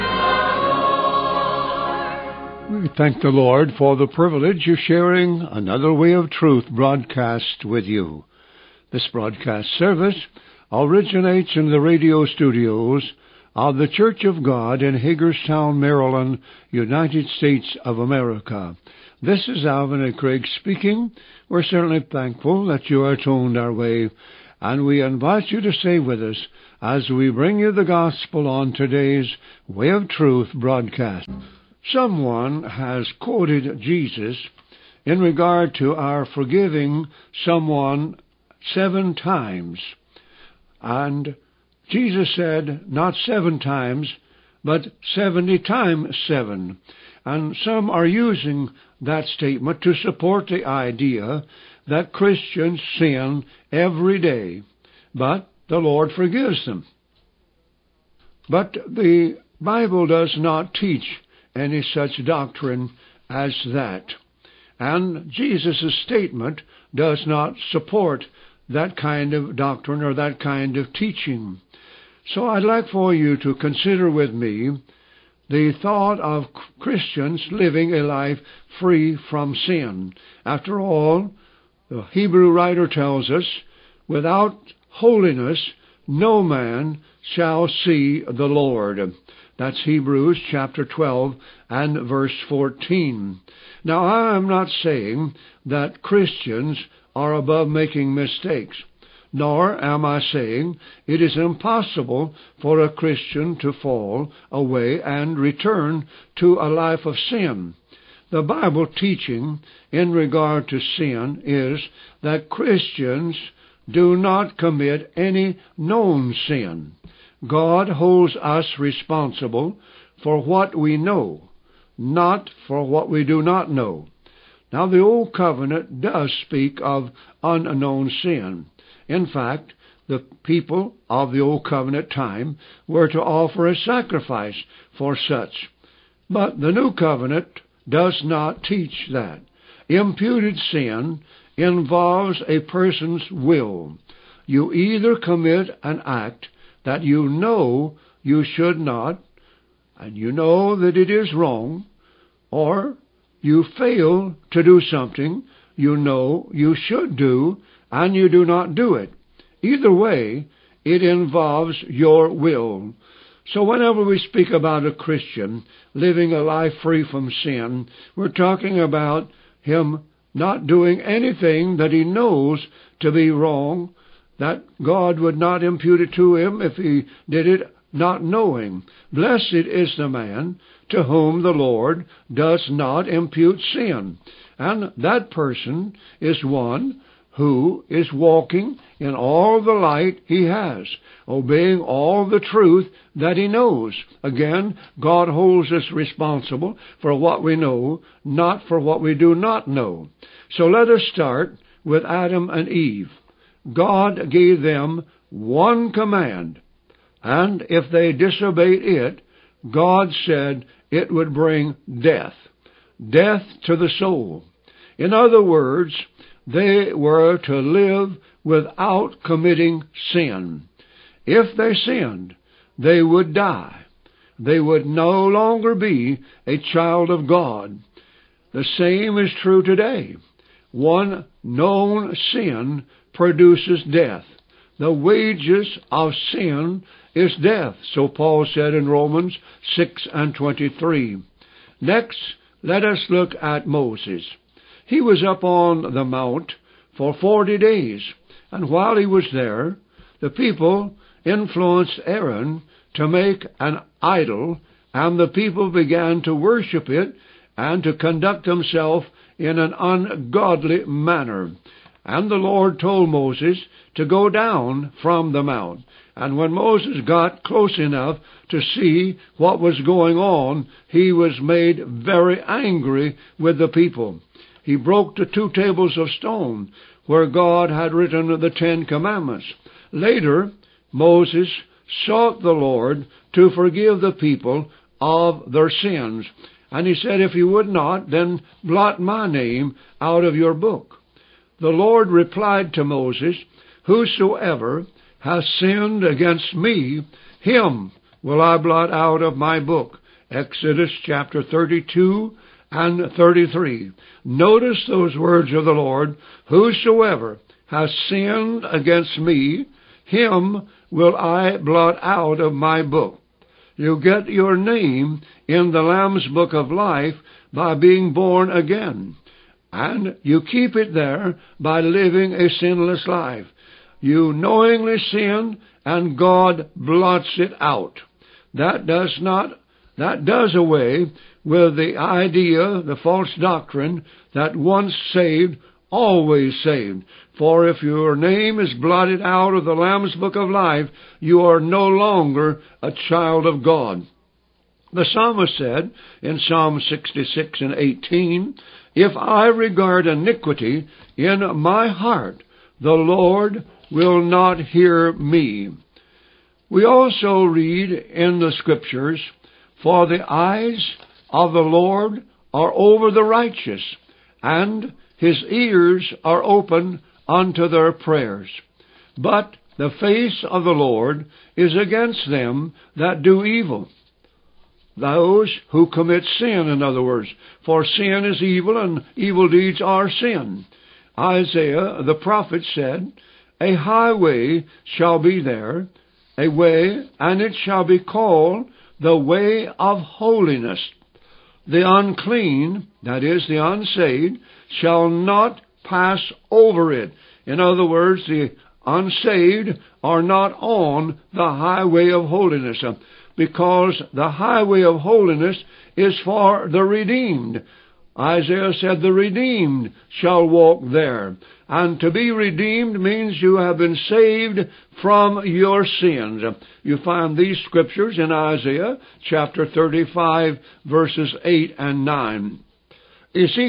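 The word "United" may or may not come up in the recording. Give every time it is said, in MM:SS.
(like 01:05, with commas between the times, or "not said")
00:16.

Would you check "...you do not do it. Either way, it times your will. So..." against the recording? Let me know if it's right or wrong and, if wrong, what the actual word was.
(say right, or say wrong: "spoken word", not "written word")
wrong: "involves", not "times".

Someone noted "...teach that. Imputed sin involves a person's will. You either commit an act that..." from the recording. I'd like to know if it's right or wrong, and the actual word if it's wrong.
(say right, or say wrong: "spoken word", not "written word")
right.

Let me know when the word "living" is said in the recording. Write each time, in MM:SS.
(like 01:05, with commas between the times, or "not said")
01:17, 02:45, 05:21.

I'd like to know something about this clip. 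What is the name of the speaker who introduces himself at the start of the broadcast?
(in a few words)
Alvin A. Craig.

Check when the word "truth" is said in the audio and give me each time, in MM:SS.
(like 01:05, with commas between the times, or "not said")
00:06, 00:30, 03:12.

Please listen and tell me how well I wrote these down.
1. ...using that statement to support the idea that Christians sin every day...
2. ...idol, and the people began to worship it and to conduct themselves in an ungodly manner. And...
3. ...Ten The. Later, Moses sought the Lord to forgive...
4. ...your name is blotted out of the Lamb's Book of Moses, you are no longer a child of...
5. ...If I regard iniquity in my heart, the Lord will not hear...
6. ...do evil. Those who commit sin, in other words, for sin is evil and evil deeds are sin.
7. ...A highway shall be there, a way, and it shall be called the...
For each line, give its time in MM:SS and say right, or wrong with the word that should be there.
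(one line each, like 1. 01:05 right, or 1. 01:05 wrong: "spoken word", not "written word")
1. 00:48 right
2. 04:14 right
3. 04:38 wrong: "Commandments", not "The"
4. 05:37 wrong: "Life", not "Moses"
5. 05:48 right
6. 06:13 right
7. 06:23 right.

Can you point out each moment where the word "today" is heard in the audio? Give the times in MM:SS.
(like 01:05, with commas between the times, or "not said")
00:28, 03:49.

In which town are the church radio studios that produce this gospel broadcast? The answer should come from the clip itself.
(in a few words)
Hagerstown, Maryland.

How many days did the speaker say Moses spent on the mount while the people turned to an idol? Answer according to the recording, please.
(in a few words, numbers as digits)
40.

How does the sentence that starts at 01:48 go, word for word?
The Bible teaching in regard to sin is that Christians do not commit any known sin.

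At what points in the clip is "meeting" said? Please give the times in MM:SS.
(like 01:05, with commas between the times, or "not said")
not said.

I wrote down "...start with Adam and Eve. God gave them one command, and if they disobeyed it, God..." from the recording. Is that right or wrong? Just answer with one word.
right.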